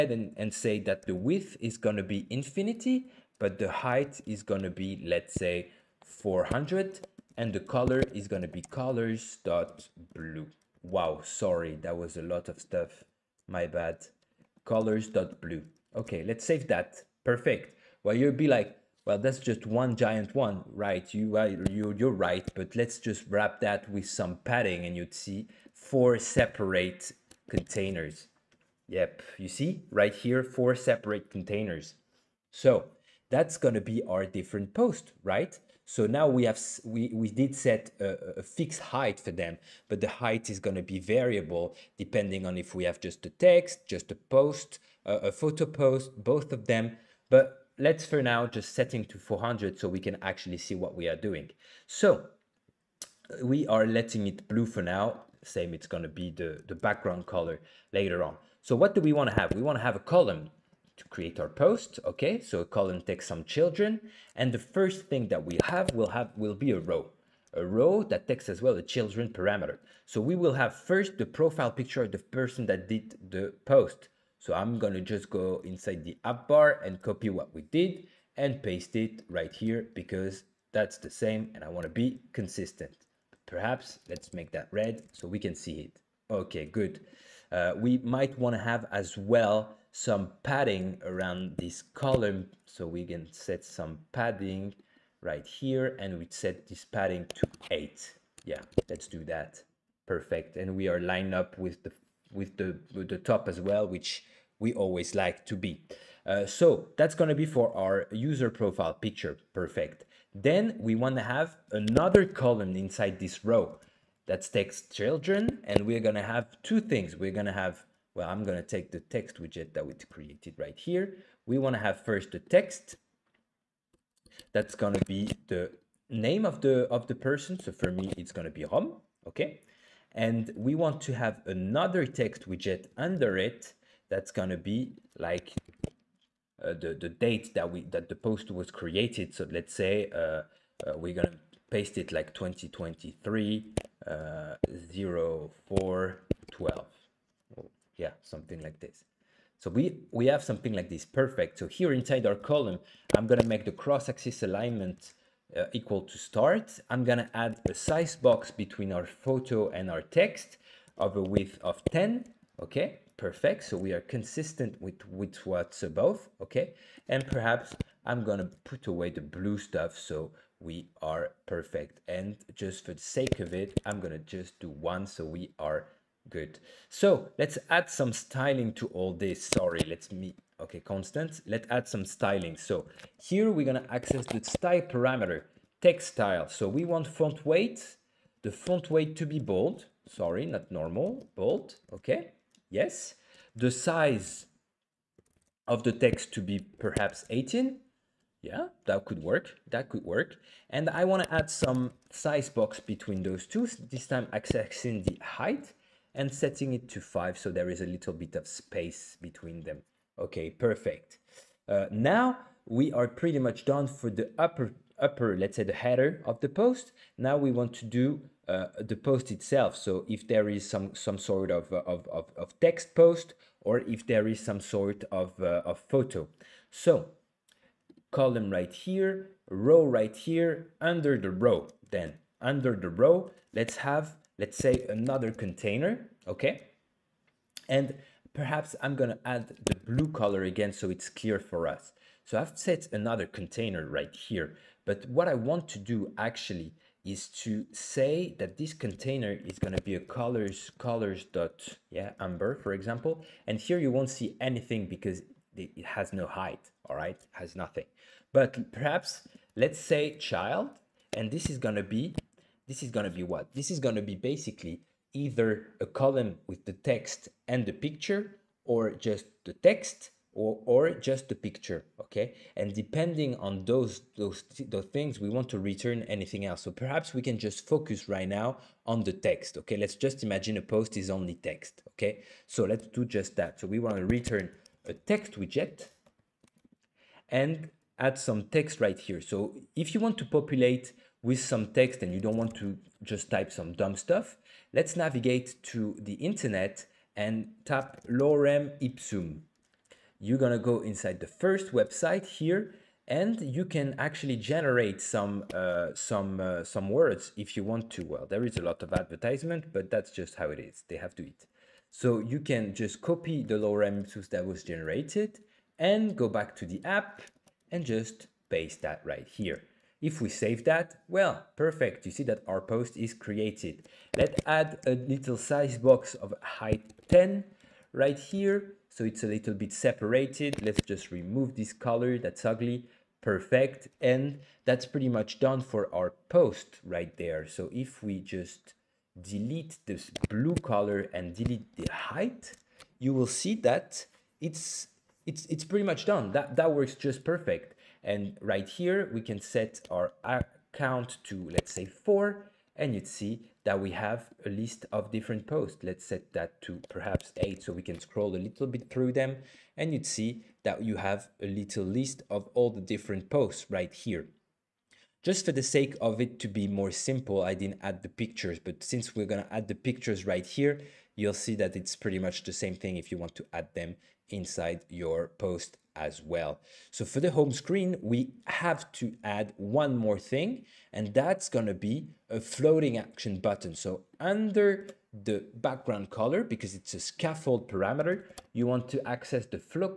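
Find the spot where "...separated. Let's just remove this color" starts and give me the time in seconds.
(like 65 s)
329 s.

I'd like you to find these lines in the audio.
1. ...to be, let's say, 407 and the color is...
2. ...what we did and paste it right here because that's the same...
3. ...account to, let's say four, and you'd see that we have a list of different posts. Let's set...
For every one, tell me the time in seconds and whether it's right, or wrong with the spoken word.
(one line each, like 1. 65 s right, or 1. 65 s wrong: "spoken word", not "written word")
1. 4 s wrong: "400", not "407"
2. 77 s right
3. 350 s right.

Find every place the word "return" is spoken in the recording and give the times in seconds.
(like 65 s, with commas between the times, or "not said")
275 s, 284 s.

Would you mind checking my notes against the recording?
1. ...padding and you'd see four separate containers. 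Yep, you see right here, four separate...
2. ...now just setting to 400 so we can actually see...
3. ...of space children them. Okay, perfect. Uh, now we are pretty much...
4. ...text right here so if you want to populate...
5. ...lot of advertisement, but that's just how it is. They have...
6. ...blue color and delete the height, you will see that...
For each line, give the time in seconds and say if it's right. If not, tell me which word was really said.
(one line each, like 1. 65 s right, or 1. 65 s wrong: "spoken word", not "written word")
1. 24 s right
2. 48 s right
3. 208 s wrong: "between", not "children"
4. 288 s right
5. 308 s right
6. 340 s right.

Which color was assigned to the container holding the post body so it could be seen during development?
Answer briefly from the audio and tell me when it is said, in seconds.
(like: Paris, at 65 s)
amber, at 252 s.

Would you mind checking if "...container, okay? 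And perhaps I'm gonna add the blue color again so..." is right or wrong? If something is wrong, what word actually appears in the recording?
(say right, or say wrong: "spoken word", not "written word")
right.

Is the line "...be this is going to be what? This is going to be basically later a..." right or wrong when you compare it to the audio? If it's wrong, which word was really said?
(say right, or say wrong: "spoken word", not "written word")
wrong: "either", not "later".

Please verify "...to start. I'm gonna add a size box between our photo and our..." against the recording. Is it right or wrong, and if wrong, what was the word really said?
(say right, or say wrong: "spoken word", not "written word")
right.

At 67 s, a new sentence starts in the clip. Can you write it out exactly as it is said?
A row that takes as well a children parameter.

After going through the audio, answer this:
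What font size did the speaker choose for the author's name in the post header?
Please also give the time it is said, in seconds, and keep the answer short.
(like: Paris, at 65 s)
18, at 197 s.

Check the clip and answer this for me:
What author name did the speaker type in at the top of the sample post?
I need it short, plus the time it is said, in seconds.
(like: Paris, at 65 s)
Rom, at 128 s.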